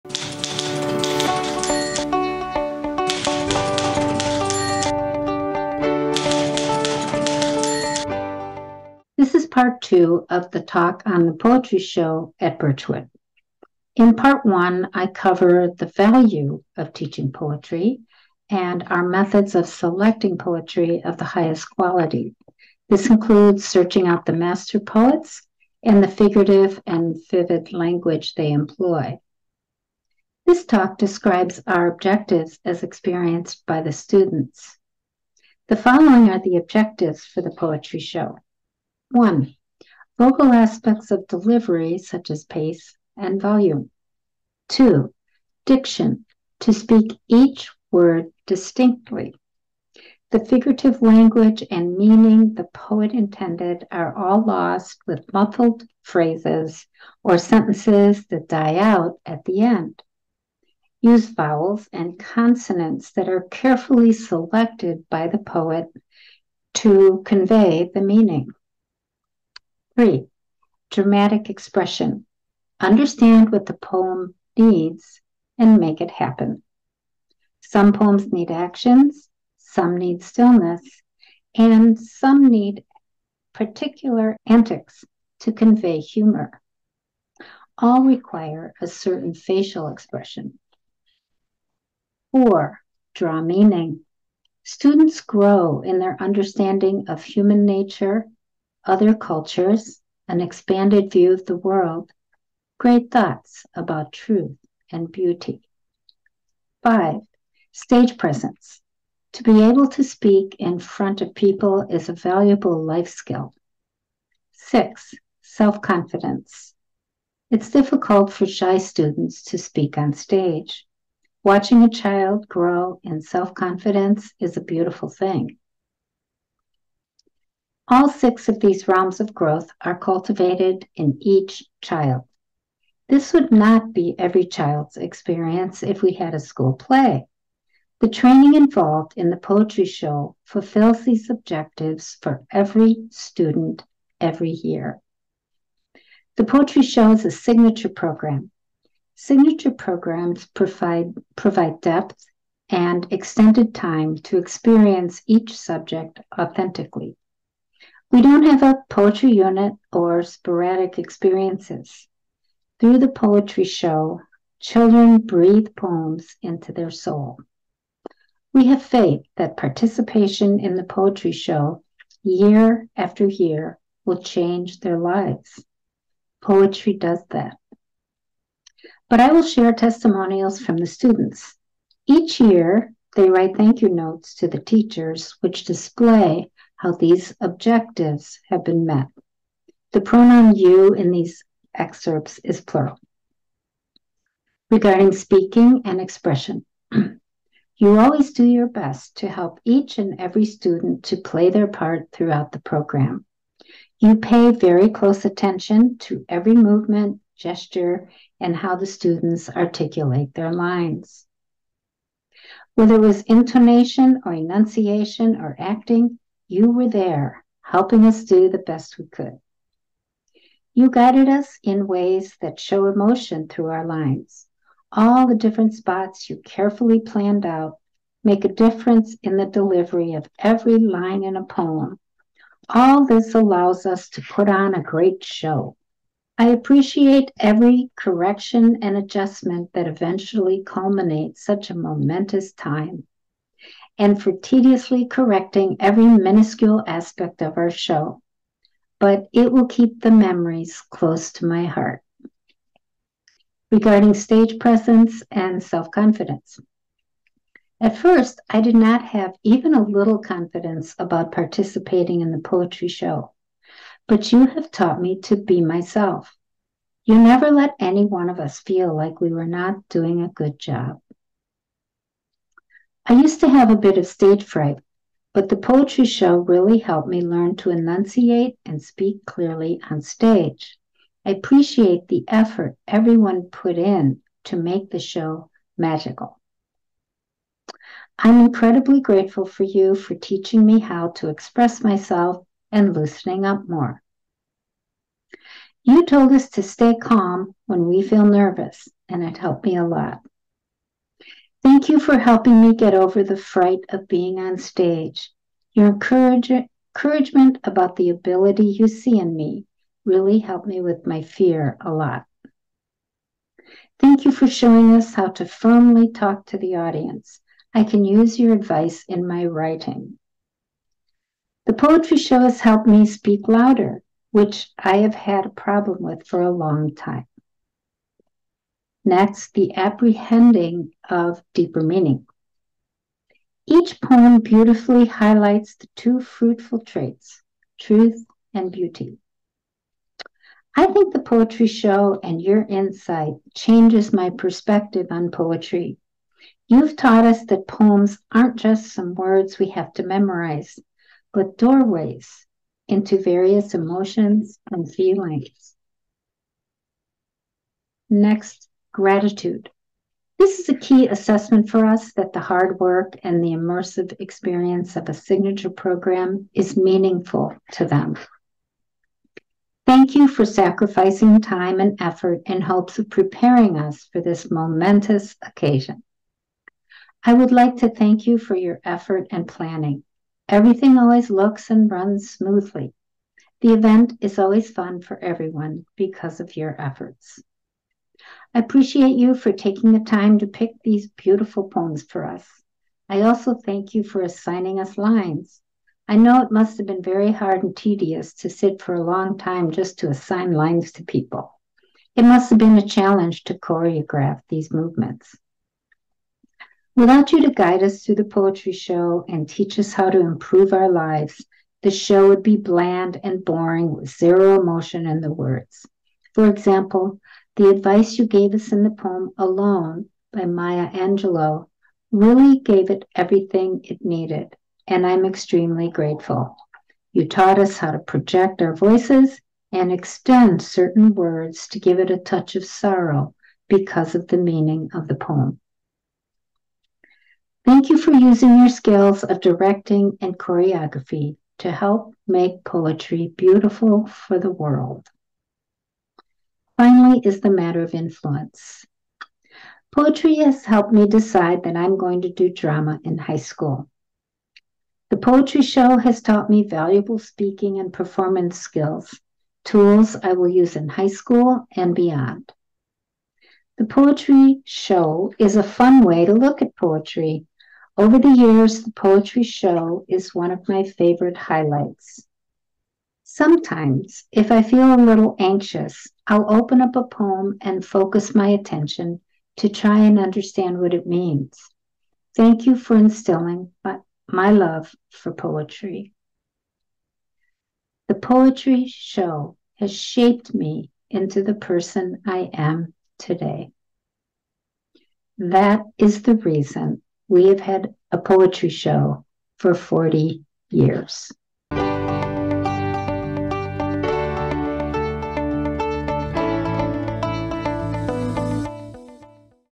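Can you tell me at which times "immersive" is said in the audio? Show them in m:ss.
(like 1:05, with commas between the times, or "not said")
6:03.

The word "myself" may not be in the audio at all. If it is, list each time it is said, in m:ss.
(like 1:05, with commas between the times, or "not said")
4:25, 4:51.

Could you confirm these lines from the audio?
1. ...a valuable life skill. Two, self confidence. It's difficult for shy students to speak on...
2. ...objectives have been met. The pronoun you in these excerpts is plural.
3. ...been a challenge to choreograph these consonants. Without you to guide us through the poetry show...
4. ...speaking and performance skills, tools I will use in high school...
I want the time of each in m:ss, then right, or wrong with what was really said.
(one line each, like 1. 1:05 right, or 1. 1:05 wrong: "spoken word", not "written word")
1. 1:52 wrong: "Six", not "Two"
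2. 3:07 right
3. 6:42 wrong: "movements", not "consonants"
4. 7:37 right.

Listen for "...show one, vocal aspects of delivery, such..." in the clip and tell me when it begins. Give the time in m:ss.
0:37.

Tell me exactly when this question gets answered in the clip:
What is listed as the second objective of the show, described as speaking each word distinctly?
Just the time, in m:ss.
0:45.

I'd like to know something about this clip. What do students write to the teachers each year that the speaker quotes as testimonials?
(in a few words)
Thank you notes.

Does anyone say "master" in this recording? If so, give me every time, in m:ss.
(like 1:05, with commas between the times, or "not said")
0:24.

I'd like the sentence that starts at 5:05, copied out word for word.
Your encouragement about the ability you see in me really helped me with my fear a lot.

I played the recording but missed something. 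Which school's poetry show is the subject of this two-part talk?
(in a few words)
Birchwood.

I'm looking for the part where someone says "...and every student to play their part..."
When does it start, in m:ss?
3:19.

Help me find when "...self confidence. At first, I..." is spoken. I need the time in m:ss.
4:15.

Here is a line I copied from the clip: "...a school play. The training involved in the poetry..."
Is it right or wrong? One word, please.
right.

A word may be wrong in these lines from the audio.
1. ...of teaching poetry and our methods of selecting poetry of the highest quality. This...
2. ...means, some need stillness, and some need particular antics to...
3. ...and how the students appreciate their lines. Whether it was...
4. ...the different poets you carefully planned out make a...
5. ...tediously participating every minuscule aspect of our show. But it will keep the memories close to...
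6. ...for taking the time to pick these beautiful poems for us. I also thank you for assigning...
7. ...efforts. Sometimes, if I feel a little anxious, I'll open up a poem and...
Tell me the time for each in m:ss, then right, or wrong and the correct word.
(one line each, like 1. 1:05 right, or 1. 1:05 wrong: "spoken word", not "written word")
1. 0:16 right
2. 1:18 wrong: "actions", not "means"
3. 3:28 wrong: "articulate", not "appreciate"
4. 3:45 wrong: "spots", not "poets"
5. 4:04 wrong: "correcting", not "participating"
6. 6:29 right
7. 7:51 wrong: "highlights", not "efforts".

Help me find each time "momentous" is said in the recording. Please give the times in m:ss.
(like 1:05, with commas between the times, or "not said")
4:01, 6:14.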